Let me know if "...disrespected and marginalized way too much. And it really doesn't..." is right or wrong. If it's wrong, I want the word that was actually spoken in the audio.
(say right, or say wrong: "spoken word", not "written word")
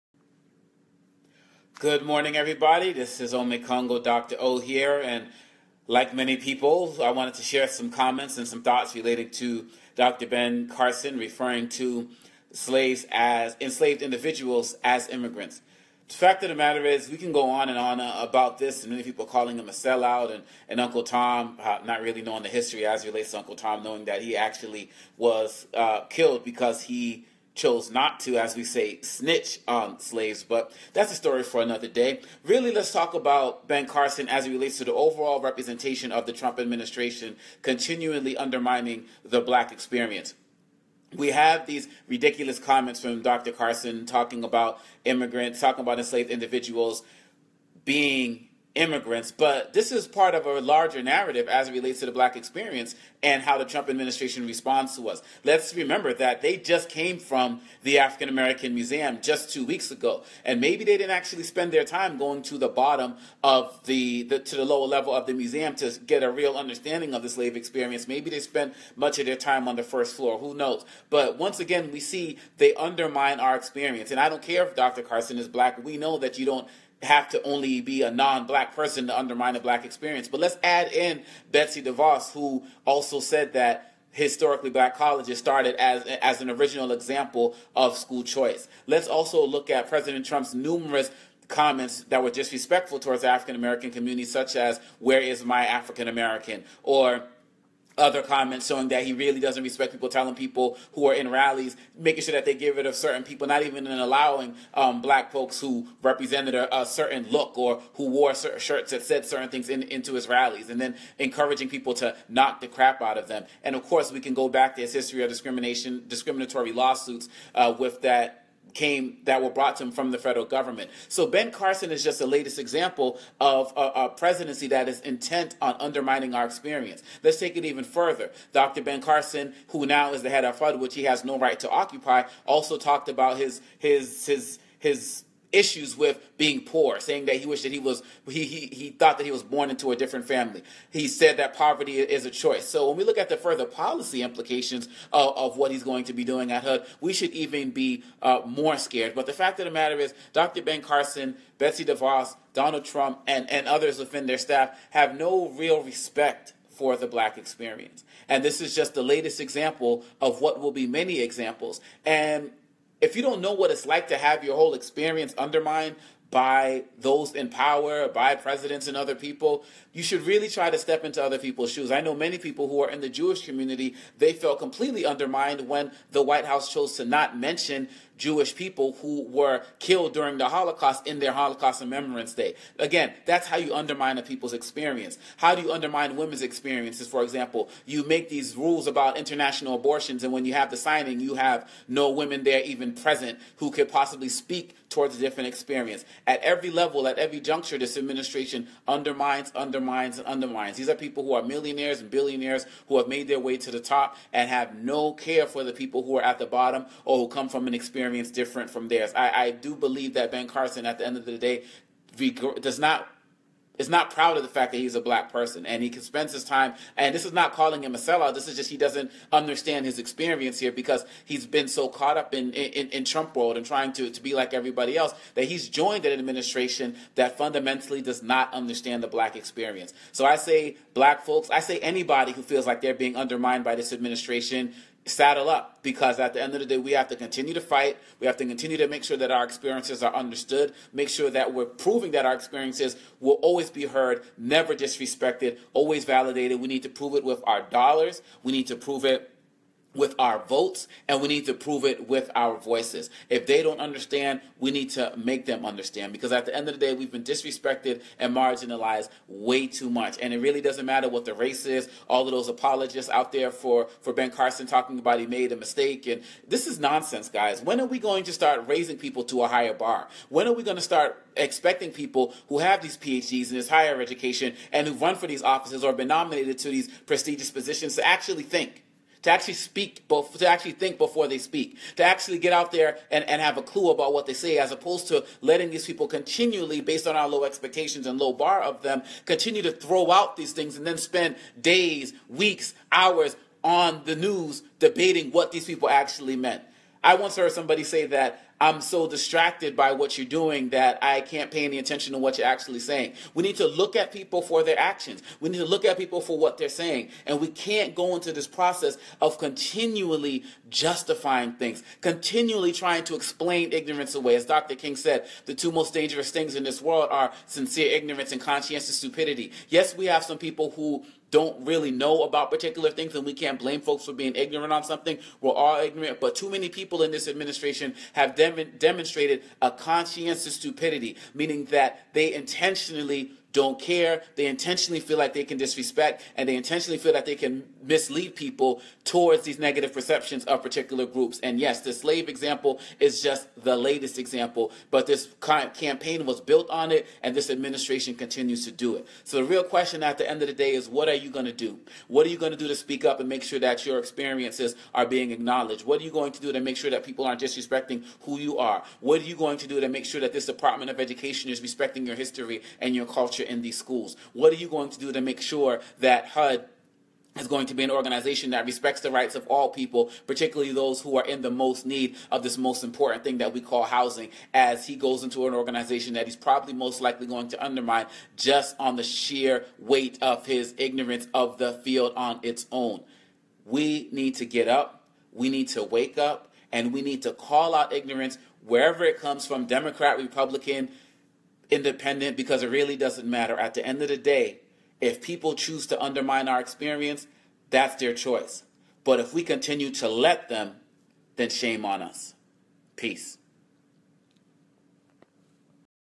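right.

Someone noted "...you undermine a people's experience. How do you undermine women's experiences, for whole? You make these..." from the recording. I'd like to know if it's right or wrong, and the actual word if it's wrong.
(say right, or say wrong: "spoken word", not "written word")
wrong: "example", not "whole".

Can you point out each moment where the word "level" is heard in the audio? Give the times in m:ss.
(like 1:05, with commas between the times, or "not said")
1:04, 3:16.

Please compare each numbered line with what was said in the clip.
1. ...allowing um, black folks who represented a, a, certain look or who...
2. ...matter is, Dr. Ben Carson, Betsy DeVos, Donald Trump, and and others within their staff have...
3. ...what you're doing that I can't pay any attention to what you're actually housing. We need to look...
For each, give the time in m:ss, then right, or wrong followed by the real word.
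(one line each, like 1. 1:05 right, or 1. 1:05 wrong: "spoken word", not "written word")
1. 1:43 right
2. 2:29 right
3. 4:59 wrong: "saying", not "housing".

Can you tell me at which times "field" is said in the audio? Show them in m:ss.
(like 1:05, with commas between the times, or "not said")
6:21.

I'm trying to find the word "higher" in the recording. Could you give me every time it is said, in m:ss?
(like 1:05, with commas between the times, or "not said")
4:29, 4:33.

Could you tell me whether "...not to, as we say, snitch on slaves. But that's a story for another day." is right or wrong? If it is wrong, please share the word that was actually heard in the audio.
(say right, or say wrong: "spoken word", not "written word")
right.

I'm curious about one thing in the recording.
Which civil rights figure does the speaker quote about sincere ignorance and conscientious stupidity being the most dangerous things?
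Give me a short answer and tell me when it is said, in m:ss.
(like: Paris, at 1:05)
Dr. King, at 5:14.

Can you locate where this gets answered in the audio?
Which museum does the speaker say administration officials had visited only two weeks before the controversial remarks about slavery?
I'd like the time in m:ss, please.
0:57.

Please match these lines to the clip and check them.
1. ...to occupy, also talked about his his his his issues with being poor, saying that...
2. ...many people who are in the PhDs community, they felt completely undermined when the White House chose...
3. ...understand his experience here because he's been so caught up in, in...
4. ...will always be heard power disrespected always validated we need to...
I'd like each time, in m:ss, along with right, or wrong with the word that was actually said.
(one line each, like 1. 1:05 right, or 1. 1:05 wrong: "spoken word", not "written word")
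1. 2:11 right
2. 2:52 wrong: "Jewish", not "PhDs"
3. 3:39 right
4. 4:03 wrong: "never", not "power".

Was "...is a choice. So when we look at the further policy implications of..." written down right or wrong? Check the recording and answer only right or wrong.
right.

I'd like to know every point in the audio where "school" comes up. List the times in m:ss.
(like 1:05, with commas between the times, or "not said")
1:27, 6:03.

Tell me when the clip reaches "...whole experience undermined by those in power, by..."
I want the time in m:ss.
2:44.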